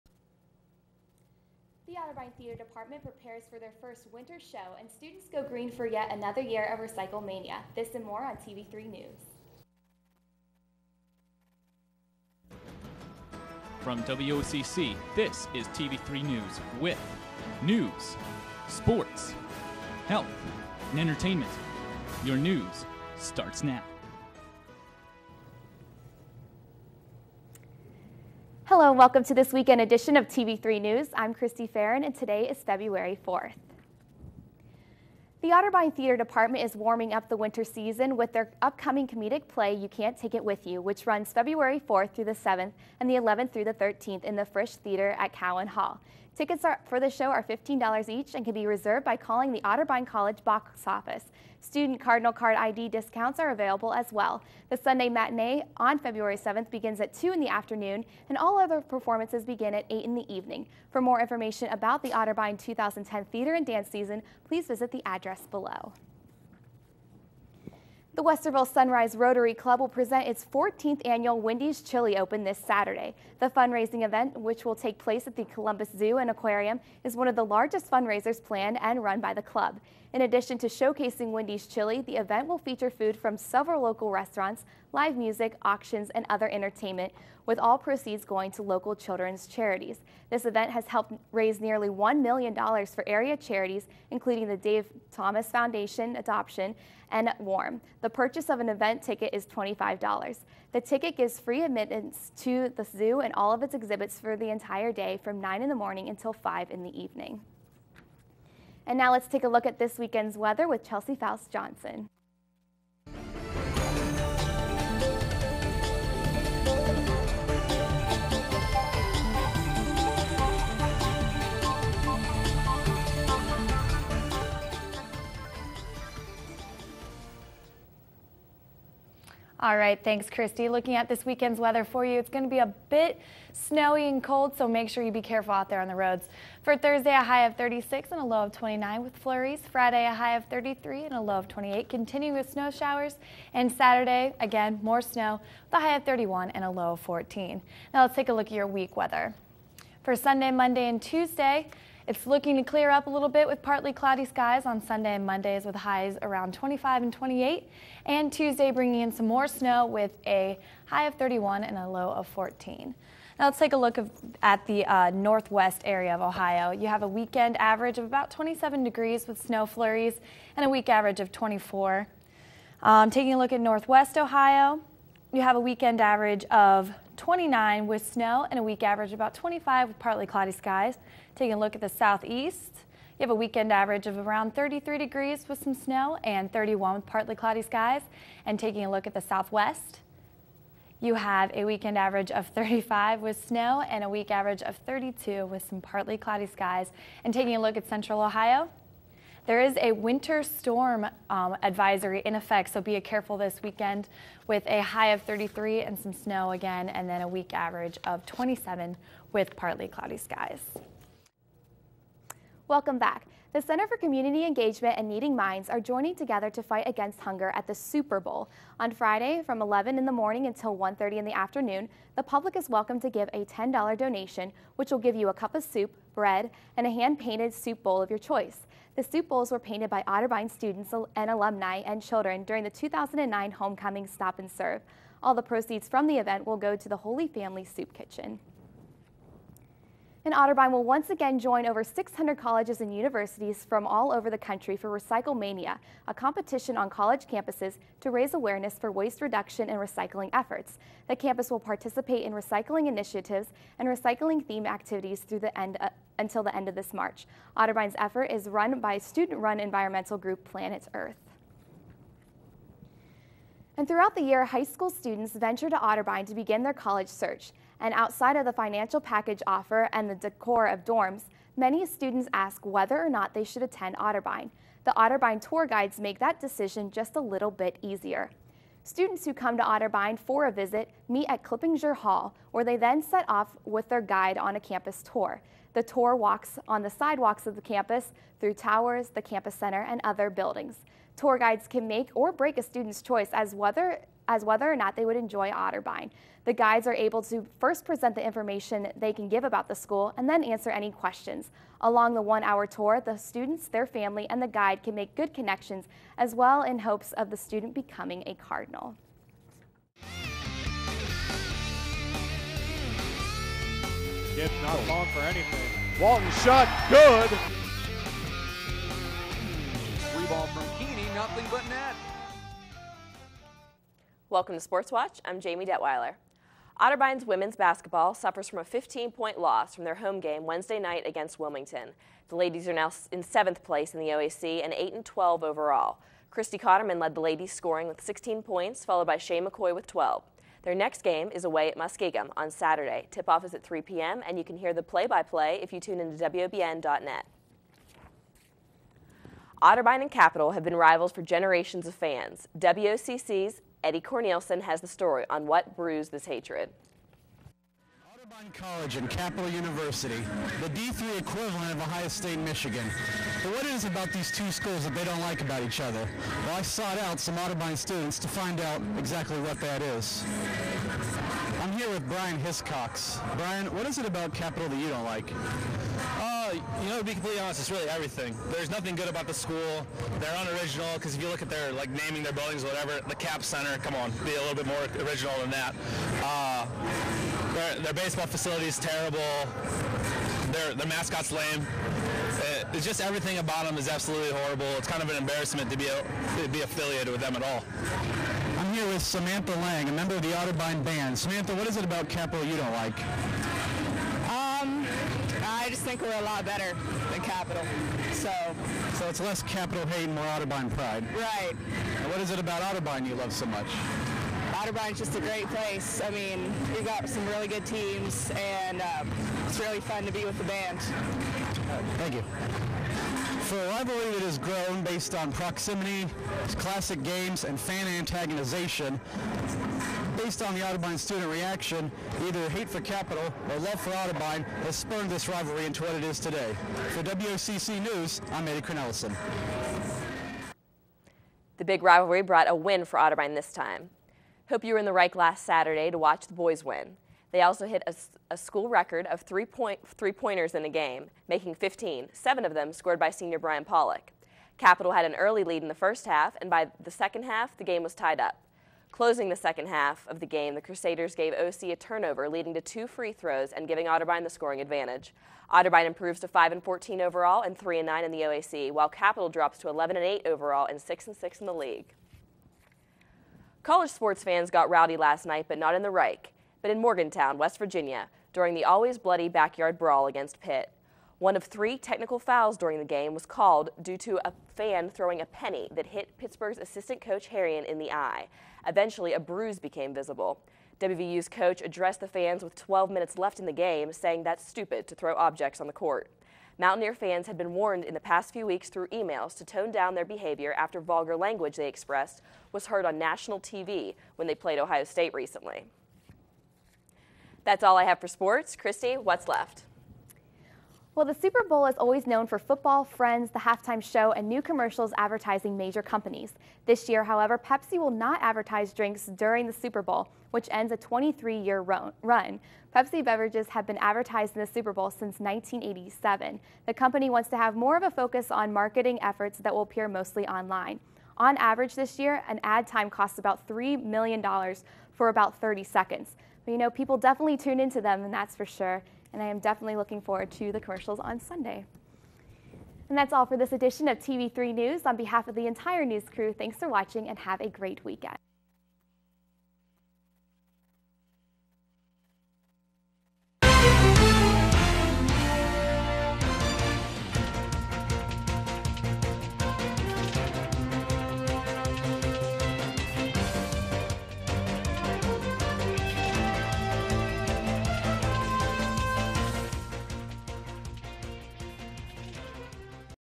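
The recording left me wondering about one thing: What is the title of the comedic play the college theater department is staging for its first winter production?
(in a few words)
You Can't Take It With You.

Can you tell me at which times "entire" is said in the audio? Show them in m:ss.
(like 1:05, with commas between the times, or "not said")
1:44, 9:05.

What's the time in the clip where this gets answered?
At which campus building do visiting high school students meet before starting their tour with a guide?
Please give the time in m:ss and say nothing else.
4:41.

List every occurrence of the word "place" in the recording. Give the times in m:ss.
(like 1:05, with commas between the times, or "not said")
1:14, 5:33, 6:55.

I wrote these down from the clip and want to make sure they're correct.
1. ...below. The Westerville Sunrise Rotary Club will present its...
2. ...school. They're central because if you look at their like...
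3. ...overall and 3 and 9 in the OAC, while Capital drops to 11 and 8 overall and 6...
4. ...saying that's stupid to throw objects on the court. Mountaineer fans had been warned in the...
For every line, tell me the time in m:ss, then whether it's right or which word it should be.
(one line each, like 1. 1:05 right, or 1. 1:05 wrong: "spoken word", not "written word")
1. 1:05 right
2. 6:19 wrong: "unoriginal", not "central"
3. 7:46 right
4. 8:13 right.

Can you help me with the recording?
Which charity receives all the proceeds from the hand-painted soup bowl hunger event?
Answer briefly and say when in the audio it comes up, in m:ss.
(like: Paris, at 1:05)
Holy Family Soup Kitchen, at 3:56.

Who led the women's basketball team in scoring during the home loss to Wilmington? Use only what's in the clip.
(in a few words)
Christy Cotterman.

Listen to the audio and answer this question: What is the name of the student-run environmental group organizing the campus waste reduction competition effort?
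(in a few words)
Planet Earth.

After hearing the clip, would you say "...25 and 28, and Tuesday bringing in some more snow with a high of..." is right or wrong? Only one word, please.
right.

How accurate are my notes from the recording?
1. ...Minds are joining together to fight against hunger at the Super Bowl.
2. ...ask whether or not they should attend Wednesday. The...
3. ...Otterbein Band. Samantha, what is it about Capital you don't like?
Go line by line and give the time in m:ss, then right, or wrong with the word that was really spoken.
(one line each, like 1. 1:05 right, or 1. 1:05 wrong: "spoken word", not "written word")
1. 3:35 right
2. 4:32 wrong: "Otterbein", not "Wednesday"
3. 6:40 right.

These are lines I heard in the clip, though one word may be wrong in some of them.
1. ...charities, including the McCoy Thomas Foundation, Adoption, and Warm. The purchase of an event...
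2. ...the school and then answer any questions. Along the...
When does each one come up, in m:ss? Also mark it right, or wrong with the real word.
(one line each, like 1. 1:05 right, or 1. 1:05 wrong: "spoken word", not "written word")
1. 1:33 wrong: "Dave", not "McCoy"
2. 4:59 right.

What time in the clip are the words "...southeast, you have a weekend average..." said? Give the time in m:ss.
3:01.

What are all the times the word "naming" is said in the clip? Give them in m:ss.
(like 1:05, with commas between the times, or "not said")
6:21.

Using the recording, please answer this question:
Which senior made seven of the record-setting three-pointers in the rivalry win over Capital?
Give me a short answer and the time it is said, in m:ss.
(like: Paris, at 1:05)
Brian Pollock, at 7:33.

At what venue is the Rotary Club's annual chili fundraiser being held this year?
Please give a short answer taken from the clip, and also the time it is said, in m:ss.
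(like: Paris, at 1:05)
Columbus Zoo and Aquarium, at 1:15.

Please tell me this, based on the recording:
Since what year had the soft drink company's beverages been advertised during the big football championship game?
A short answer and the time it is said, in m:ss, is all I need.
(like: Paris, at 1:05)
1987, at 8:45.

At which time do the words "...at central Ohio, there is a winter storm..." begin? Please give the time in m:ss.
3:17.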